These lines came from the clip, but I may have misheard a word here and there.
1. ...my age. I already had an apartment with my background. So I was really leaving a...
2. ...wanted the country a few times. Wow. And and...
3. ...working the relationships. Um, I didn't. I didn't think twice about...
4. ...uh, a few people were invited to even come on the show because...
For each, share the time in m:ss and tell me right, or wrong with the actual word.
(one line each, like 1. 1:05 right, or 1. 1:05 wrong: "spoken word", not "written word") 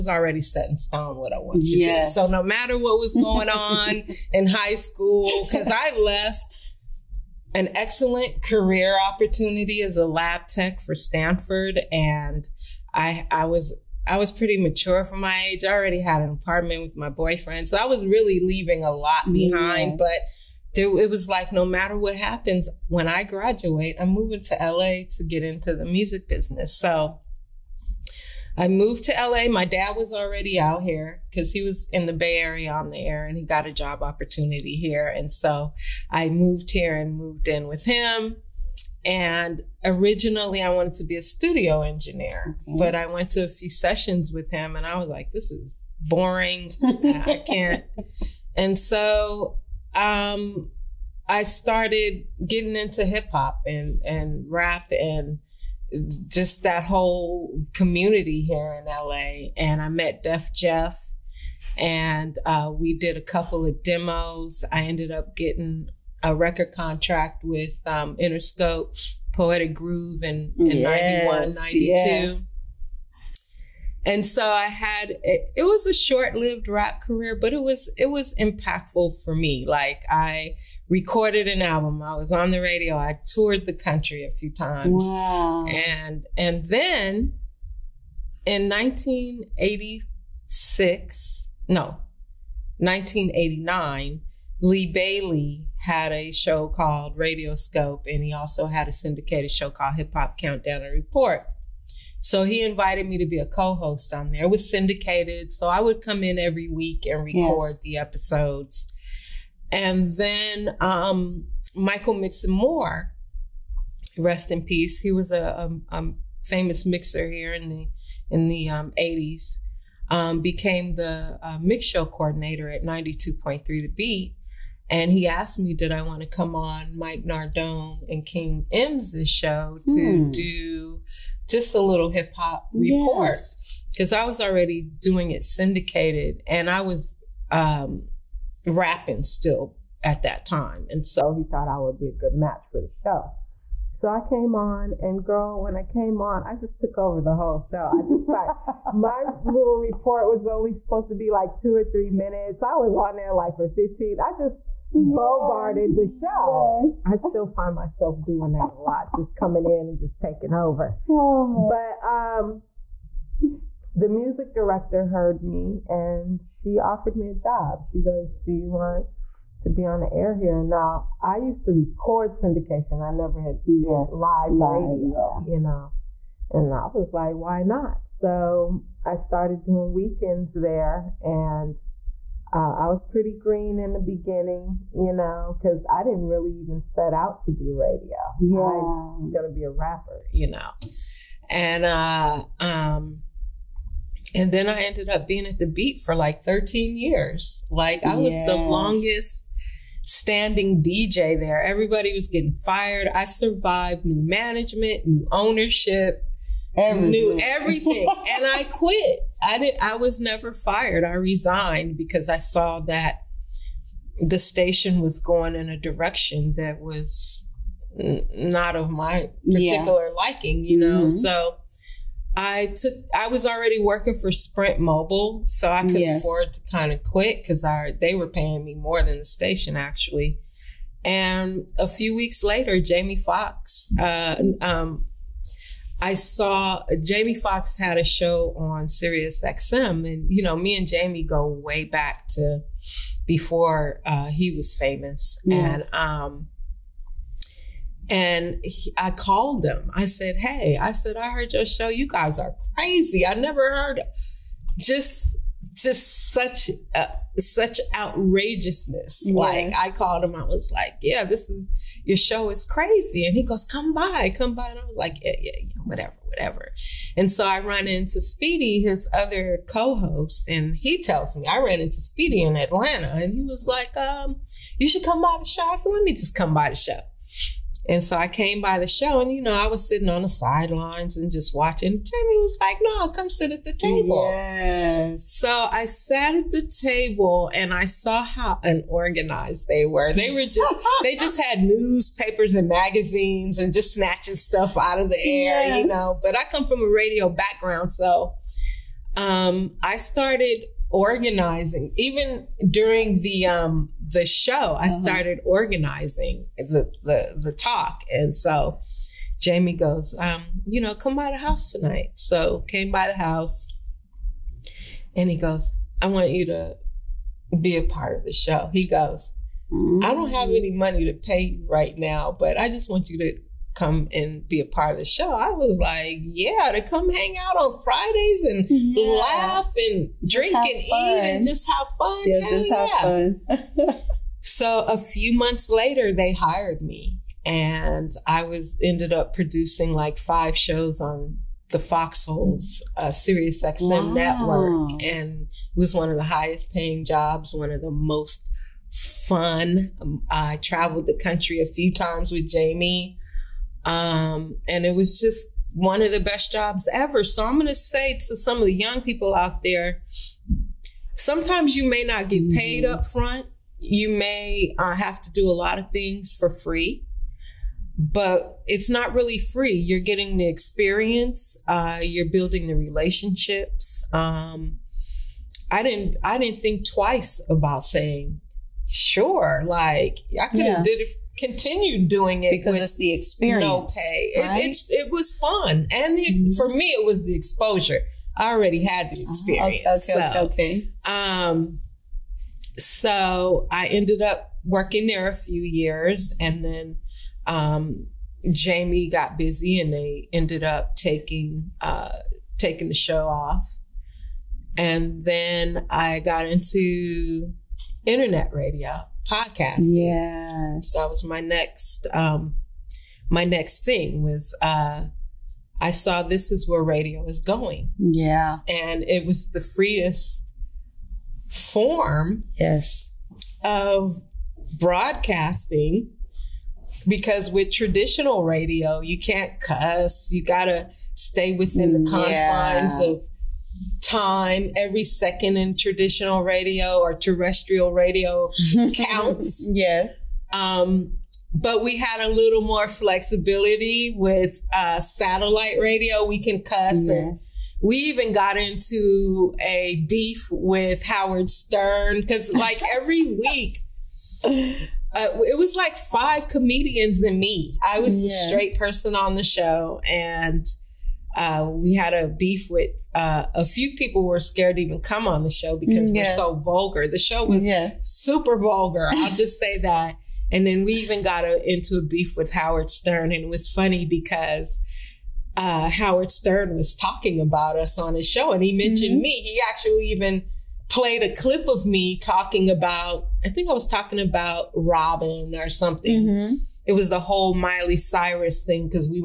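1. 0:15 wrong: "boyfriend", not "background"
2. 1:23 wrong: "toured", not "wanted"
3. 6:12 wrong: "building", not "working"
4. 7:43 wrong: "scared", not "invited".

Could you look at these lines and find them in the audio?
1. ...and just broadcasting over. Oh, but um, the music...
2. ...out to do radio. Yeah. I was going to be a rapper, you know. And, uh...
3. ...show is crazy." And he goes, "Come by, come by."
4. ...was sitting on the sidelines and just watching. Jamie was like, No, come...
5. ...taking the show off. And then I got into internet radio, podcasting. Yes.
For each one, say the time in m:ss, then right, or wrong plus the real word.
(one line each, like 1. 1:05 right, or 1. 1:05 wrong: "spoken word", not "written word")
1. 2:39 wrong: "taking", not "broadcasting"
2. 3:07 right
3. 4:22 right
4. 4:39 right
5. 6:42 right.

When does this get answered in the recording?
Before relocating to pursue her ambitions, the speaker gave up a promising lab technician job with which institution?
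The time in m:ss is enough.
0:10.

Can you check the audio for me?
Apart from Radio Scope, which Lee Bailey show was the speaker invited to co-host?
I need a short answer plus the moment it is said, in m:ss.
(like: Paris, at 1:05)
Hip Hop Countdown and Report, at 1:39.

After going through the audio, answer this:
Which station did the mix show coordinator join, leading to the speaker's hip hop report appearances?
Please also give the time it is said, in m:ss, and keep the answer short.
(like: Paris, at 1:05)
92.3 The Beat, at 2:02.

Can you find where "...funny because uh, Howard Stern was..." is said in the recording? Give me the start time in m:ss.
7:53.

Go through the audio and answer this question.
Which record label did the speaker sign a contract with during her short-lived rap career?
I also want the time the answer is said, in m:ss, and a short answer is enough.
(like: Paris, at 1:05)
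Interscope, at 1:08.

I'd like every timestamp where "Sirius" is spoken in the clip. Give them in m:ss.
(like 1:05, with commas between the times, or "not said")
3:58, 5:43.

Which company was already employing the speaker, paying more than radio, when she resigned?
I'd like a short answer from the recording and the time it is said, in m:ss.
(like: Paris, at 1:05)
Sprint Mobile, at 3:44.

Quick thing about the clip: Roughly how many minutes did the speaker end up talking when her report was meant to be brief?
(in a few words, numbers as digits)
15.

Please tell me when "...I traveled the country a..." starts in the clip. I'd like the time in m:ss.
5:50.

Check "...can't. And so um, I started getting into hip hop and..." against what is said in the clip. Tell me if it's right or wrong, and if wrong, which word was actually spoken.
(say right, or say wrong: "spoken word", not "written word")
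right.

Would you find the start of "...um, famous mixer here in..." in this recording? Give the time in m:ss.
1:55.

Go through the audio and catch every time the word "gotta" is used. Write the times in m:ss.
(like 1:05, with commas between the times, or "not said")
7:10.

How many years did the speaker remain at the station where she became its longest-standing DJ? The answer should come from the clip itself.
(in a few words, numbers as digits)
13 years.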